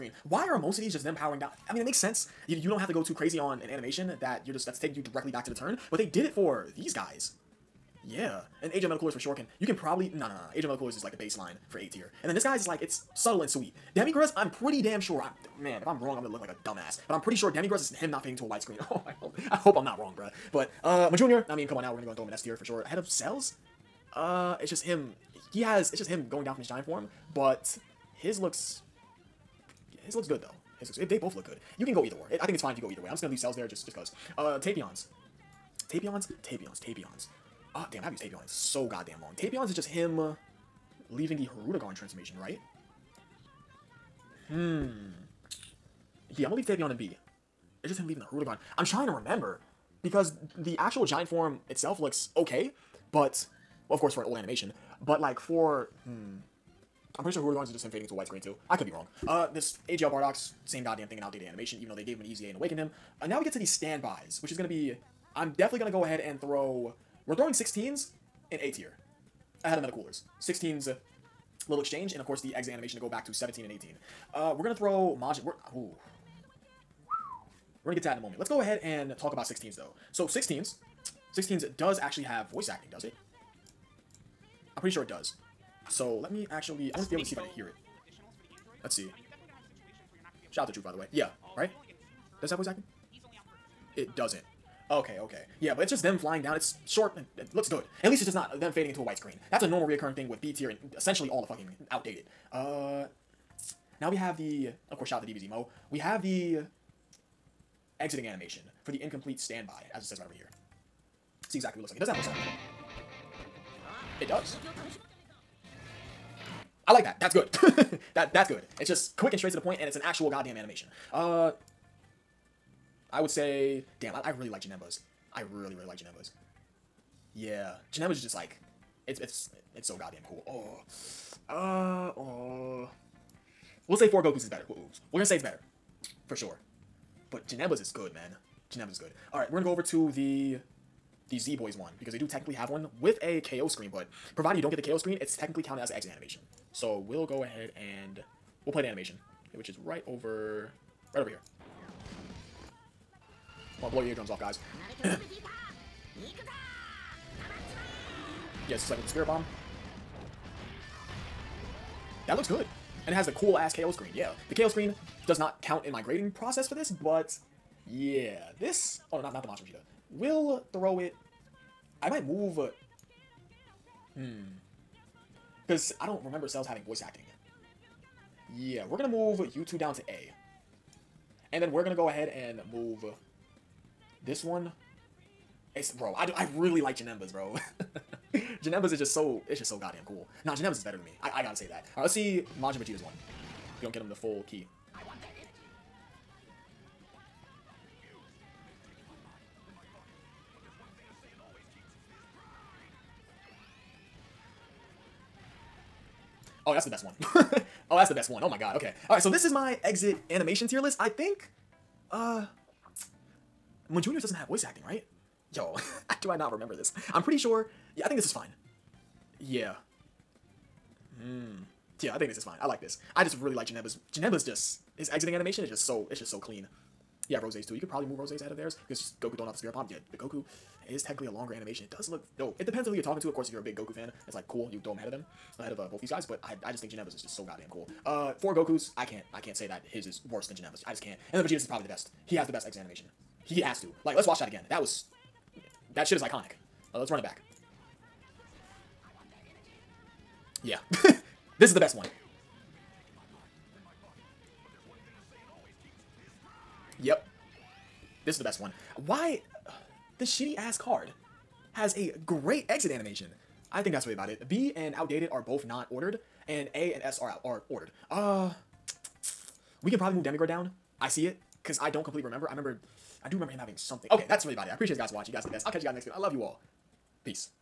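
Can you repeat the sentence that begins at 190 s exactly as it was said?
Nah, Janembas is better than me.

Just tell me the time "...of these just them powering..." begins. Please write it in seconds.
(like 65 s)
0 s.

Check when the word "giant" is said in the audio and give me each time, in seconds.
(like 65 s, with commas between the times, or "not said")
26 s, 51 s.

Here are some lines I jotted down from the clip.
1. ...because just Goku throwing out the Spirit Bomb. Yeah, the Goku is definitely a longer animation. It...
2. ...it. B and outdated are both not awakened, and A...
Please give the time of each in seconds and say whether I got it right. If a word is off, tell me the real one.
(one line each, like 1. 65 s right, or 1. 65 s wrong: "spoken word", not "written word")
1. 228 s wrong: "technically", not "definitely"
2. 264 s wrong: "ordered", not "awakened".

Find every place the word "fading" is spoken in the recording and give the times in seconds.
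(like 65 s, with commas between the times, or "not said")
18 s, 57 s, 98 s.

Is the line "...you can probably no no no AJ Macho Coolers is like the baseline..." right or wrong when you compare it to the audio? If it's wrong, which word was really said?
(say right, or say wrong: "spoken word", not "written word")
wrong: "Metal", not "Macho".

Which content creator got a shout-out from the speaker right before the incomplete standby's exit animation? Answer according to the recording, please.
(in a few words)
dbzMoe.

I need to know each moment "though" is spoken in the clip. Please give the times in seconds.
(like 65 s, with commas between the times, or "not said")
30 s, 61 s, 79 s.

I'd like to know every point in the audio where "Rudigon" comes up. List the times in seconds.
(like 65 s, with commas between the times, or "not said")
48 s, 57 s.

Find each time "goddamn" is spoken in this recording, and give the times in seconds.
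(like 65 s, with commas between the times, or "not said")
38 s, 60 s, 120 s, 129 s, 189 s, 237 s.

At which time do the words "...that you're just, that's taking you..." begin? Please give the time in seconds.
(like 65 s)
4 s.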